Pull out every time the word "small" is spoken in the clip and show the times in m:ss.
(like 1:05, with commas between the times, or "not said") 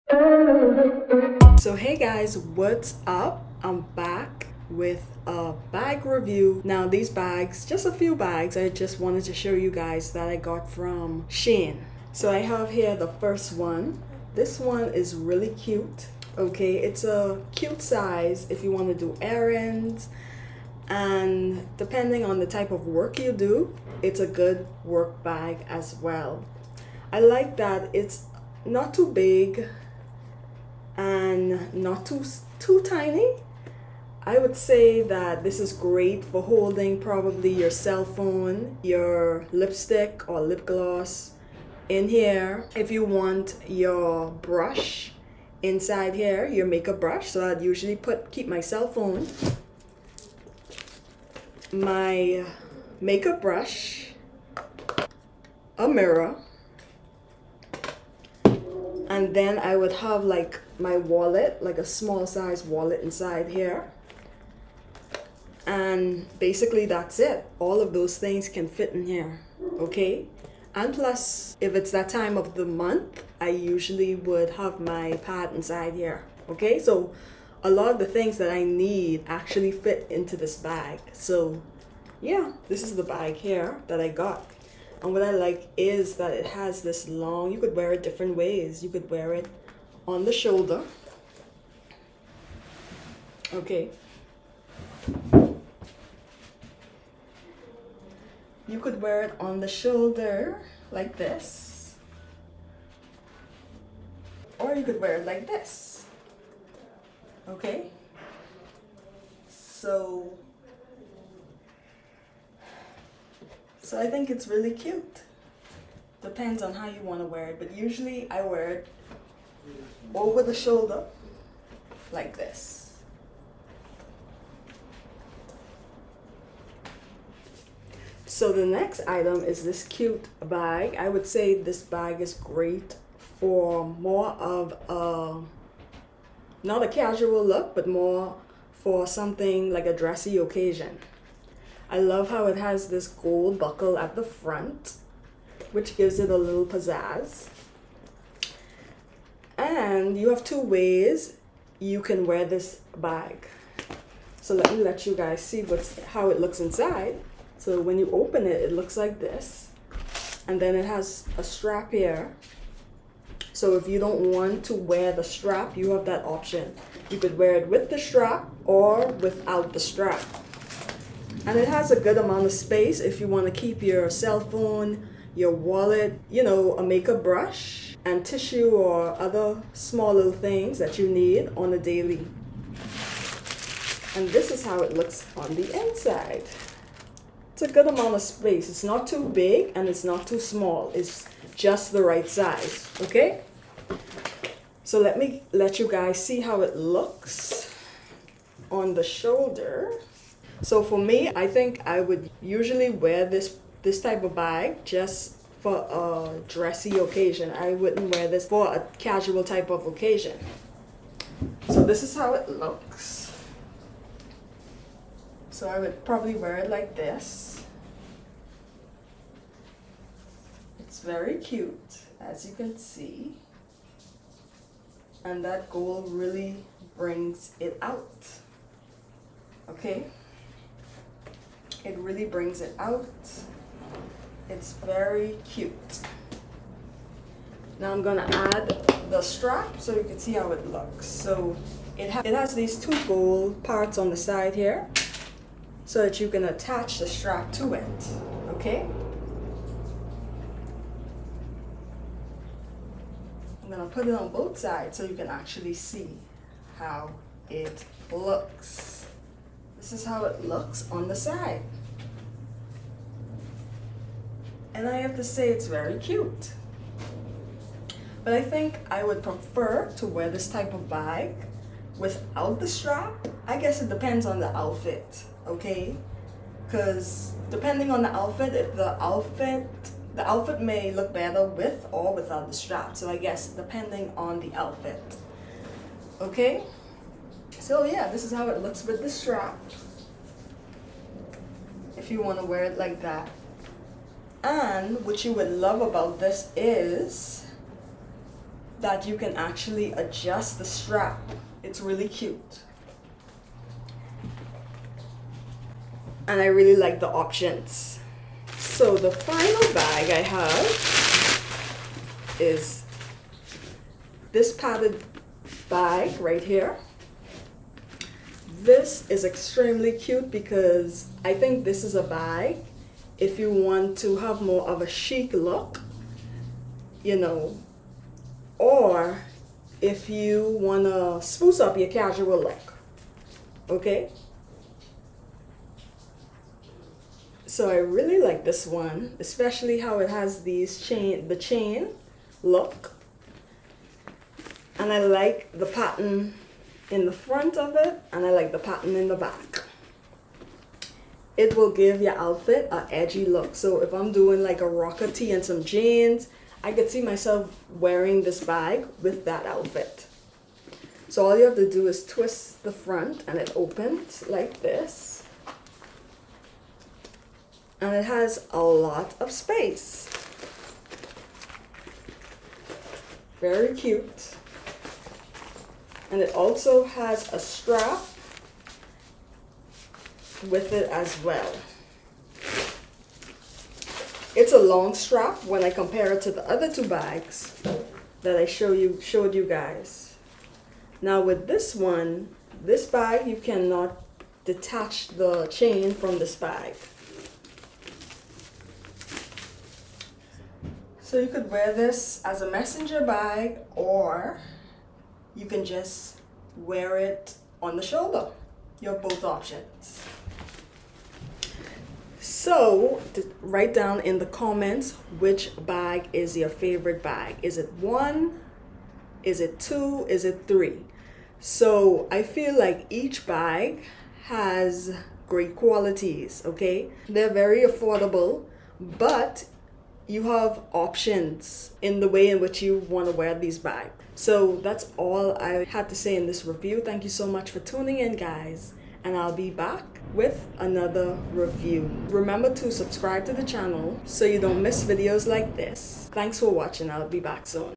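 1:01, 2:59, 3:10.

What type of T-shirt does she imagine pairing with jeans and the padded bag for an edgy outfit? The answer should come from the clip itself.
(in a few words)
A rocker tee.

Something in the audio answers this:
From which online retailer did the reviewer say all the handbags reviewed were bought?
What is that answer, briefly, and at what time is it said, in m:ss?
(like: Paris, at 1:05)
Shein, at 0:11.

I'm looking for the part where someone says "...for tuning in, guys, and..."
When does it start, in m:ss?
7:17.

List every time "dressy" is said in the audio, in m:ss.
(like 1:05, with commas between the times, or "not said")
2:19, 3:26.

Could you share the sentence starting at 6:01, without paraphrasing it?
So all you have to do is twist the front and it opens like this.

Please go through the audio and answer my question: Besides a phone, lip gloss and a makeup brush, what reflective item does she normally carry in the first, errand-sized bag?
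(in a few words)
A mirror.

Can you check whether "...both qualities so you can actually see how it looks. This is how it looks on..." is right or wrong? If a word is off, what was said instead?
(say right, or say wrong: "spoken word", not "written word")
wrong: "sides", not "qualities".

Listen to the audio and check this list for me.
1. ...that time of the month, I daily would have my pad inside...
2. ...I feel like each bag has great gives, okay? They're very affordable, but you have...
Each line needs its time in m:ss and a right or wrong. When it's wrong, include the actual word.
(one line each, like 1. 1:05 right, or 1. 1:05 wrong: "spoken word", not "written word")
1. 1:11 wrong: "usually", not "daily"
2. 7:02 wrong: "qualities", not "gives".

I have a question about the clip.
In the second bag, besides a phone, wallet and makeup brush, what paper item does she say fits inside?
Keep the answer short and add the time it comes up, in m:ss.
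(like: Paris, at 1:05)
Tissue, at 2:58.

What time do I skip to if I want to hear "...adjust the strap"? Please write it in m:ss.
4:59.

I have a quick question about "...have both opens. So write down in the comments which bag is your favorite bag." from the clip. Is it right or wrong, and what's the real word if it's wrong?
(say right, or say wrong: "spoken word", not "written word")
wrong: "options", not "opens".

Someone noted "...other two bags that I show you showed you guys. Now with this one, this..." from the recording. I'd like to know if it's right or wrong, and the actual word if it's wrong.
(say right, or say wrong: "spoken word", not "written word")
right.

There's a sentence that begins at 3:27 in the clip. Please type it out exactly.
I wouldn't wear this for a casual type of occasion.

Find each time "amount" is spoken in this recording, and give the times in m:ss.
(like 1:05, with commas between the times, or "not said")
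2:52, 3:07.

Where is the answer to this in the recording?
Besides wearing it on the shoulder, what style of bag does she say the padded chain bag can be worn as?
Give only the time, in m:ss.
6:42.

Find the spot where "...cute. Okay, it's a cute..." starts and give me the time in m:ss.
0:15.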